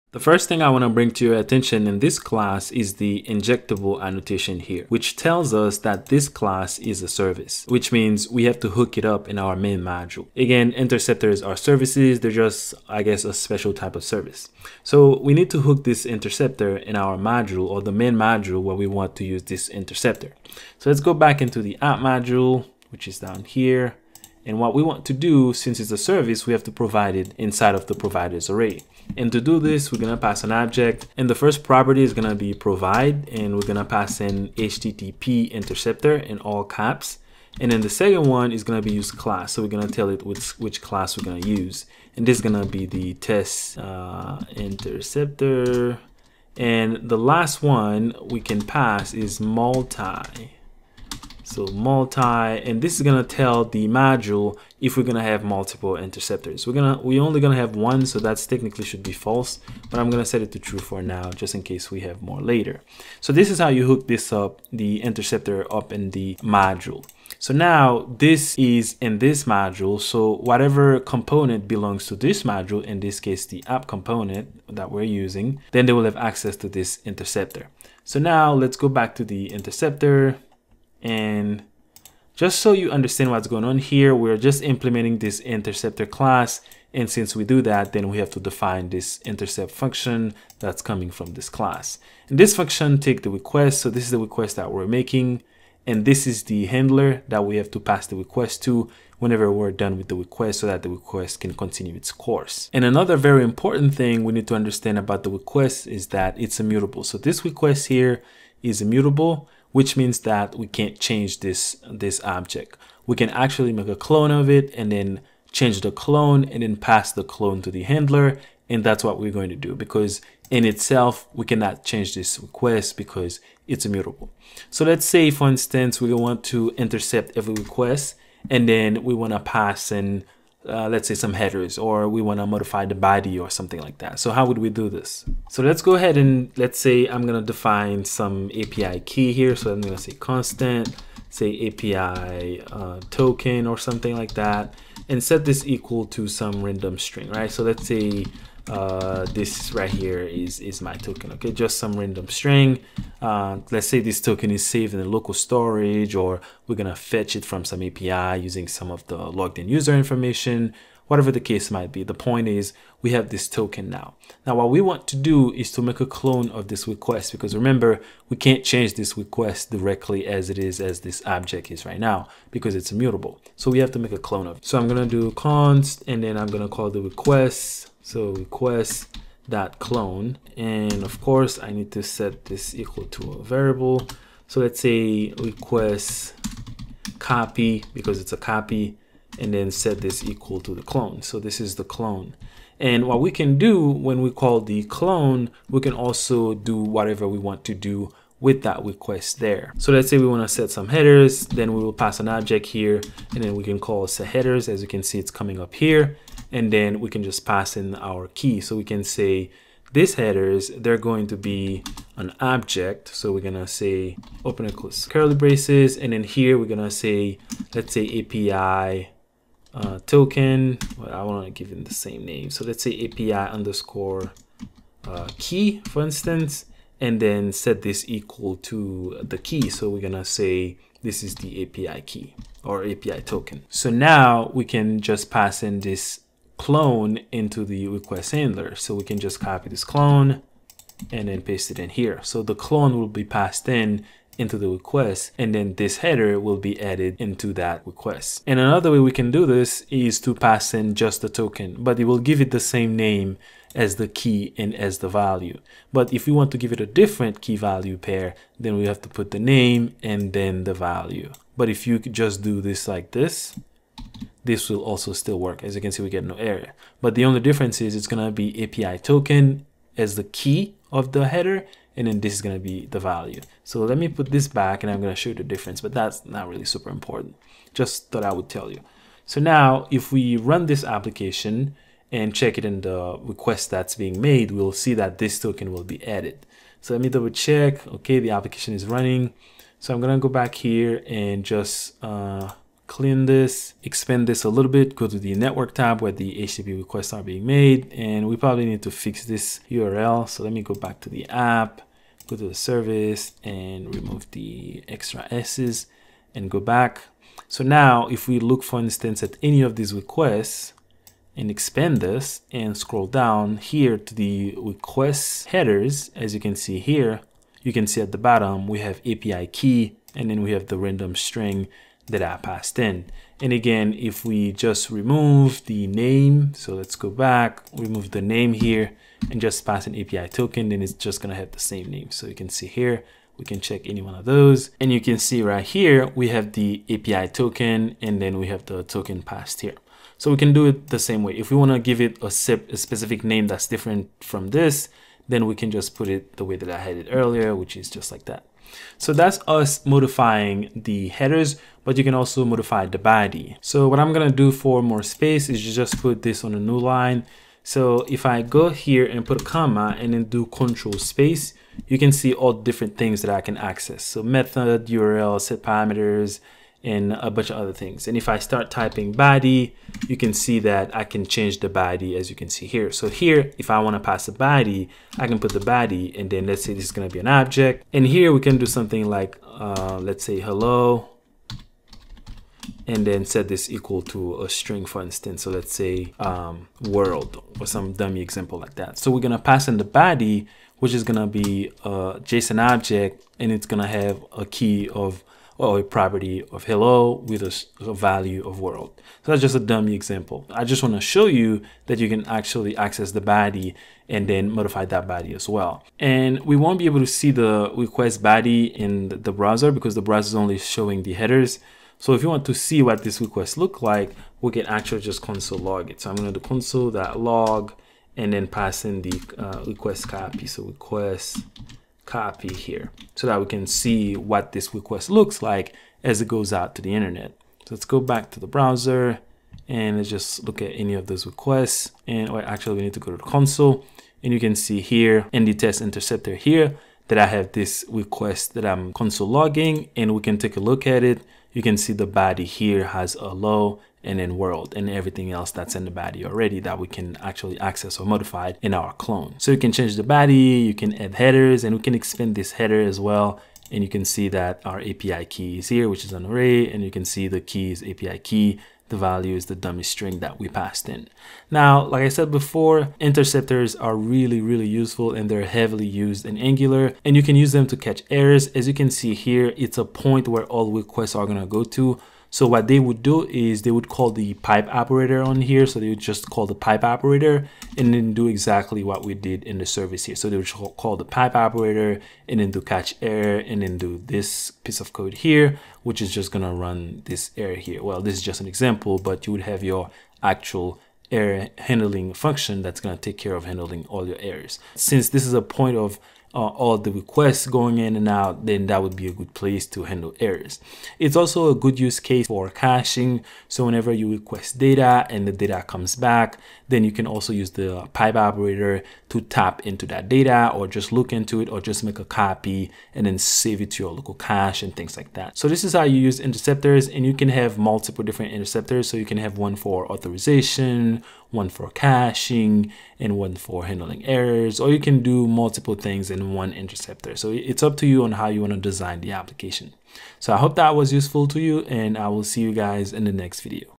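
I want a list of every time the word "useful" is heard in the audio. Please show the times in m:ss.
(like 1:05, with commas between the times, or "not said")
7:44, 8:50.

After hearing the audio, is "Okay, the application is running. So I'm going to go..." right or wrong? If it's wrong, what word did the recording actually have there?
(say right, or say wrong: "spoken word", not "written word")
right.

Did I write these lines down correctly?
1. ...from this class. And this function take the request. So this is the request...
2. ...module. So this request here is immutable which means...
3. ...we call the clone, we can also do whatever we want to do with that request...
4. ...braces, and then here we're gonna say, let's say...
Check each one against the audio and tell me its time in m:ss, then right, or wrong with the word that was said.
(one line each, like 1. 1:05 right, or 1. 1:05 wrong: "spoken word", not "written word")
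1. 1:31 right
2. 1:46 wrong: "immutable", not "module"
3. 3:14 right
4. 3:35 right.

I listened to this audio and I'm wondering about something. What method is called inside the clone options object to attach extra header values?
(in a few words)
set headers.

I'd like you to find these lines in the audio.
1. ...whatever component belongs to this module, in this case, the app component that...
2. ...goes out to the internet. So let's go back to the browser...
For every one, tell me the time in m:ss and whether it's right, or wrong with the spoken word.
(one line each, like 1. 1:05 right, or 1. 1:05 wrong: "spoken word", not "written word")
1. 1:10 right
2. 7:06 right.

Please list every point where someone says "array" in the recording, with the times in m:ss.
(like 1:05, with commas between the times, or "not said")
0:28, 7:36.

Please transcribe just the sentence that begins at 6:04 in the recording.
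So method, URL, set parameters, and a bunch of other things.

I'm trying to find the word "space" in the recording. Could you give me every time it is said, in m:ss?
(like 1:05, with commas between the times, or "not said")
5:55, 6:00.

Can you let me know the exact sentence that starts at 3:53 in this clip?
So now we can just pass in this clone into the request handler.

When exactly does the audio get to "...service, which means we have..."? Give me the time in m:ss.
0:07.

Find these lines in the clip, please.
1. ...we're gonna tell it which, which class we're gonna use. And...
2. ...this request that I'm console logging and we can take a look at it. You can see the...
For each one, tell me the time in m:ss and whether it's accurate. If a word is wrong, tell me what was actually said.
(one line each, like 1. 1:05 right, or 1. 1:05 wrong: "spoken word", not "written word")
1. 0:39 right
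2. 7:17 right.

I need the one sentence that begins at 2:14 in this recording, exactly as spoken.
So how would we do this?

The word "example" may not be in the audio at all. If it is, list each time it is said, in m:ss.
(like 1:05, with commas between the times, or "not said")
6:28, 6:39, 8:08.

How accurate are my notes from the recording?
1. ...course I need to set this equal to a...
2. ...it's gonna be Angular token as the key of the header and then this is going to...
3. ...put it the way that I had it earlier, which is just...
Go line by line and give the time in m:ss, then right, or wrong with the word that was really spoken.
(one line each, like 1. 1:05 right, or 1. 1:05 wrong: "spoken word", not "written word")
1. 3:01 right
2. 4:27 wrong: "API", not "Angular"
3. 5:45 right.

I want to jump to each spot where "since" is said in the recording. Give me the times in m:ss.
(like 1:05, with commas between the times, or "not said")
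0:25, 1:27, 8:14.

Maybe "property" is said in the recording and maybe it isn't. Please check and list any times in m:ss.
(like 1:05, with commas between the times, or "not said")
0:31, 6:35.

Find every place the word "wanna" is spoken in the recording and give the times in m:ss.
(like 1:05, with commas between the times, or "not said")
3:20, 5:41.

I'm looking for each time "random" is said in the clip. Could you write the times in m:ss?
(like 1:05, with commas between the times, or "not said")
2:26, 2:31, 5:20.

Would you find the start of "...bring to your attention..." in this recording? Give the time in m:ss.
0:00.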